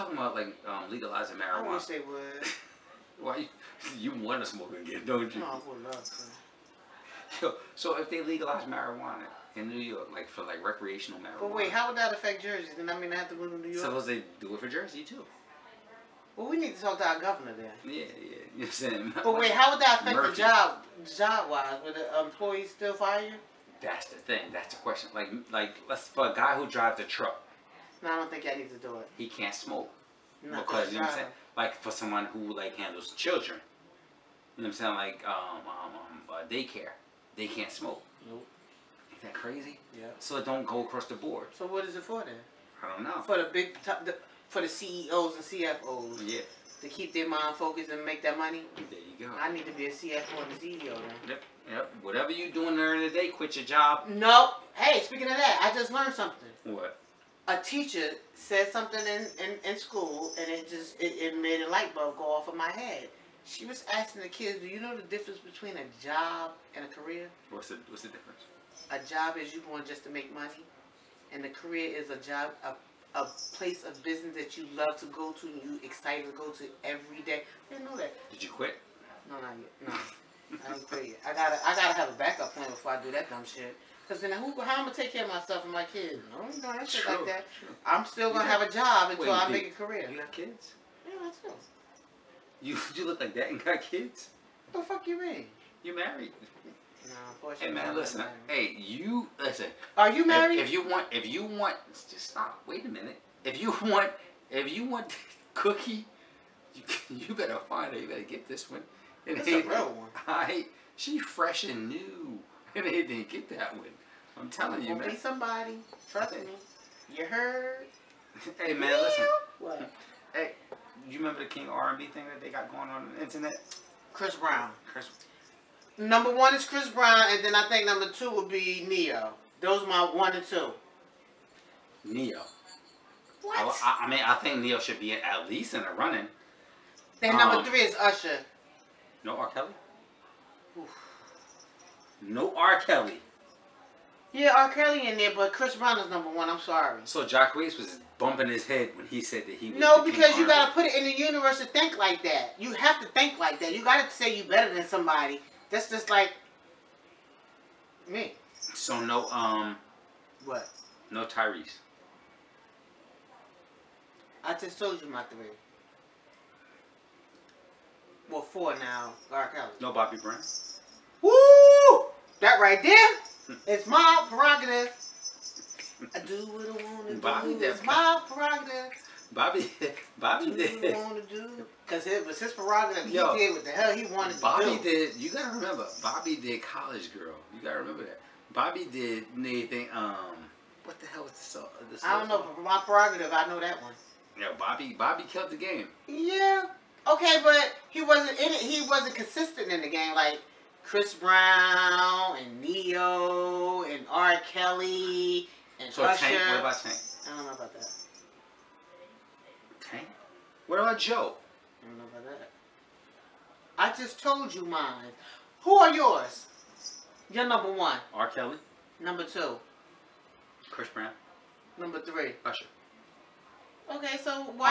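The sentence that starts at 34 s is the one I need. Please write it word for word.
Like um, um, um uh, daycare, they can't smoke.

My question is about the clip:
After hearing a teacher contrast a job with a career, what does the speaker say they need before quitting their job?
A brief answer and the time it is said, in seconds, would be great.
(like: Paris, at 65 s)
A backup plan, at 82 s.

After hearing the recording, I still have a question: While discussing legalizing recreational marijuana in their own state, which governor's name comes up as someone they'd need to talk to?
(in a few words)
Murphy.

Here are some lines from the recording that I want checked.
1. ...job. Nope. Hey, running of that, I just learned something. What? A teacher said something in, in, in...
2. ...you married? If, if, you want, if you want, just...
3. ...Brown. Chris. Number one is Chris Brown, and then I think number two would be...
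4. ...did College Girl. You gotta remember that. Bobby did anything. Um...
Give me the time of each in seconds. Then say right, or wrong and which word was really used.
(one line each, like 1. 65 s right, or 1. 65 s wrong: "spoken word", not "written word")
1. 53 s wrong: "speaking", not "running"
2. 100 s right
3. 124 s right
4. 186 s right.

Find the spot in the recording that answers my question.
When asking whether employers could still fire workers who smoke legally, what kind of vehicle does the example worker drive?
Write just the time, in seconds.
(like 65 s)
27 s.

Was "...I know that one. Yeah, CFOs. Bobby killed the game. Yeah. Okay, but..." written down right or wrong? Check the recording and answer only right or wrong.
wrong.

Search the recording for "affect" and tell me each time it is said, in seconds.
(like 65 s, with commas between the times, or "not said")
12 s, 20 s.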